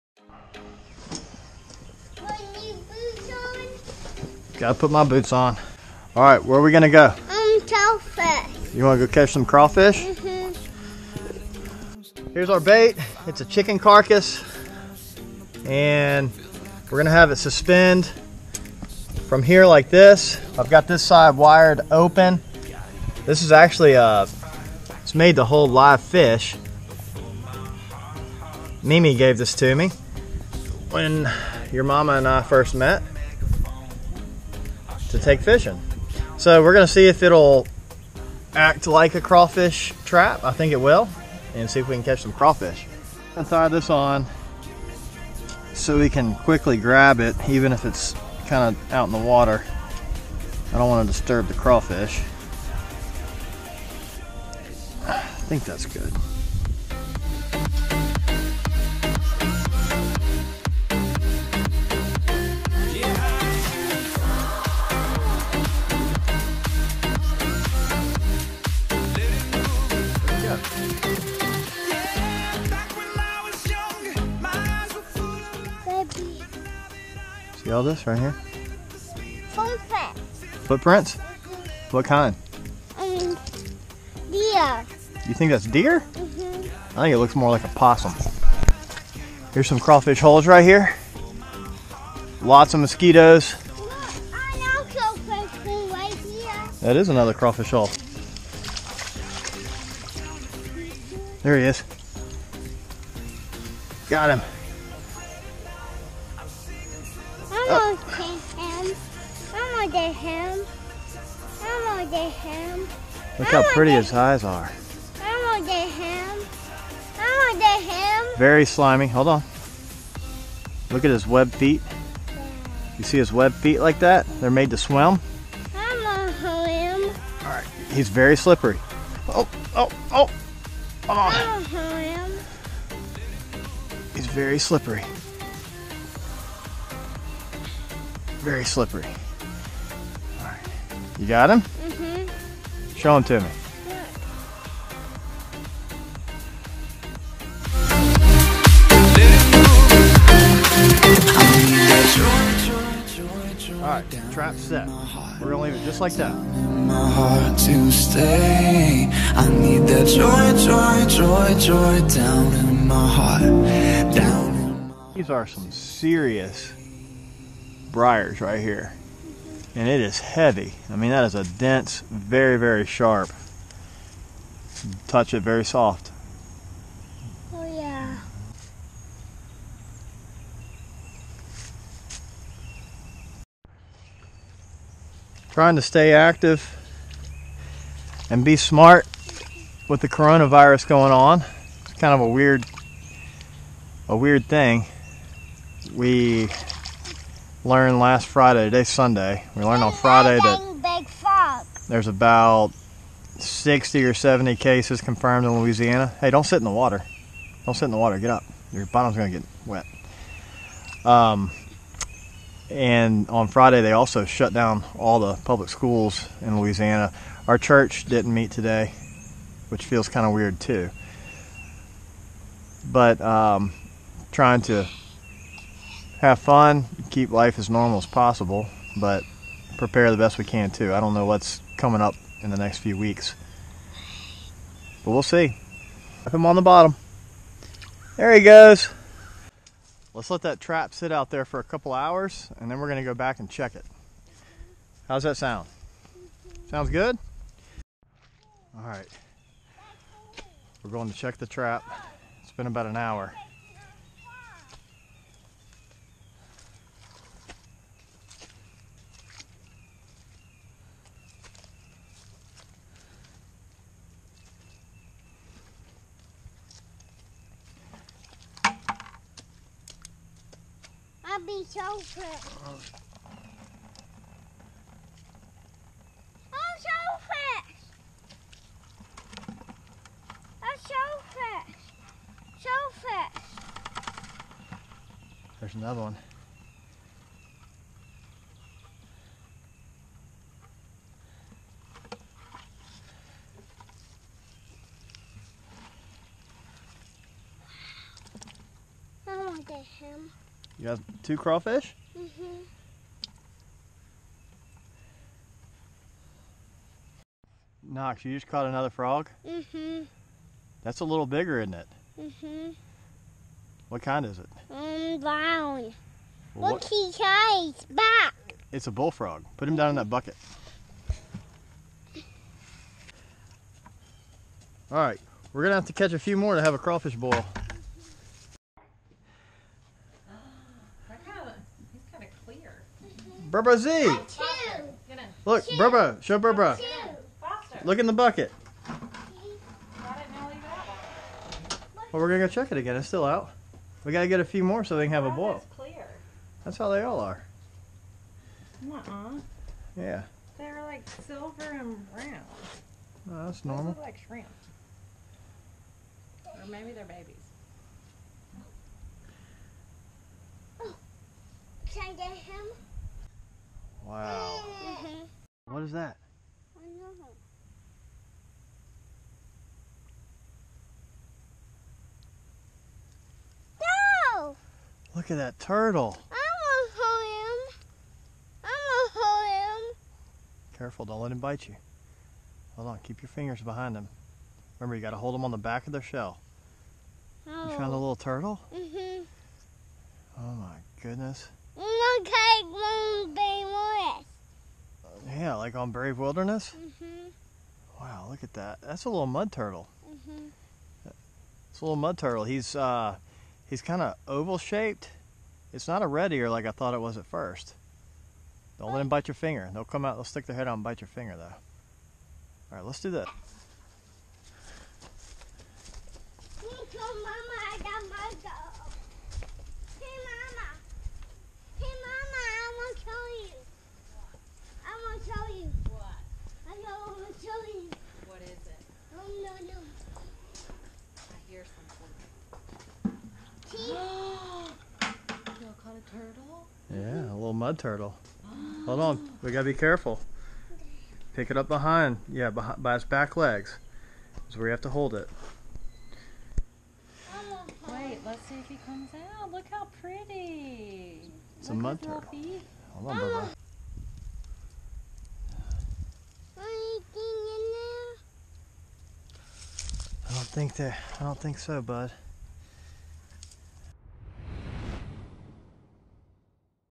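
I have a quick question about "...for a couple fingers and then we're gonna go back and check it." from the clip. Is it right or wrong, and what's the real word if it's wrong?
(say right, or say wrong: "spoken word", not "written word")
wrong: "hours", not "fingers".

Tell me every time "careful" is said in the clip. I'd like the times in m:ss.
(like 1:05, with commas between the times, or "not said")
6:20, 7:19.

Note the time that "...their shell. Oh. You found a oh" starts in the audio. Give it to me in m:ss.
6:25.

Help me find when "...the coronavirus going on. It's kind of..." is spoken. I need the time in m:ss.
3:10.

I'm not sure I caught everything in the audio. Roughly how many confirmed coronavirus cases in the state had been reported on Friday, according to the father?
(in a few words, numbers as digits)
60 or 70.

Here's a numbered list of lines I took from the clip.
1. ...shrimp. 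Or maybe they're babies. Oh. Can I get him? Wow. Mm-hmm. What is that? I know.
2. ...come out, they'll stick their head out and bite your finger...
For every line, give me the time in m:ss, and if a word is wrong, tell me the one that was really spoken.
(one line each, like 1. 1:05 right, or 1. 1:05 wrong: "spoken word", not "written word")
1. 5:54 right
2. 6:49 right.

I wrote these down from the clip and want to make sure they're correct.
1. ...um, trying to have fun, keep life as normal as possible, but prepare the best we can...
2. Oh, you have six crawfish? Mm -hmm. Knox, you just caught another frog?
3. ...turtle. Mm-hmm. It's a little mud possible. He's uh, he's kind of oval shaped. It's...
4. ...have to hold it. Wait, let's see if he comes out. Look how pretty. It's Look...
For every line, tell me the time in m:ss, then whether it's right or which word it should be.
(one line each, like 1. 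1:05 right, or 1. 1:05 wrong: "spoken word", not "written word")
1. 3:43 right
2. 5:00 wrong: "two", not "six"
3. 6:39 wrong: "turtle", not "possible"
4. 7:24 right.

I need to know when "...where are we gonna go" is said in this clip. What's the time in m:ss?
0:06.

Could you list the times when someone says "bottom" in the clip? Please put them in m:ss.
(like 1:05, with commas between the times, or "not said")
3:28, 3:56.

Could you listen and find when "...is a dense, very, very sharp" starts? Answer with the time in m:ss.
2:51.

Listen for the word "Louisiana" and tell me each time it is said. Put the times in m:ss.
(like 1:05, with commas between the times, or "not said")
3:25, 3:36.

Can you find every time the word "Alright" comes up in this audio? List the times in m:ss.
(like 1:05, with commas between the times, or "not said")
2:33.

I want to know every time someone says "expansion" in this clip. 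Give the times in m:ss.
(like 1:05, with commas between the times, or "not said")
not said.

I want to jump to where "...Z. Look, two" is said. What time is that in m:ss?
5:33.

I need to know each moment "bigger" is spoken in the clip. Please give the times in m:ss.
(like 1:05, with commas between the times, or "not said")
5:11.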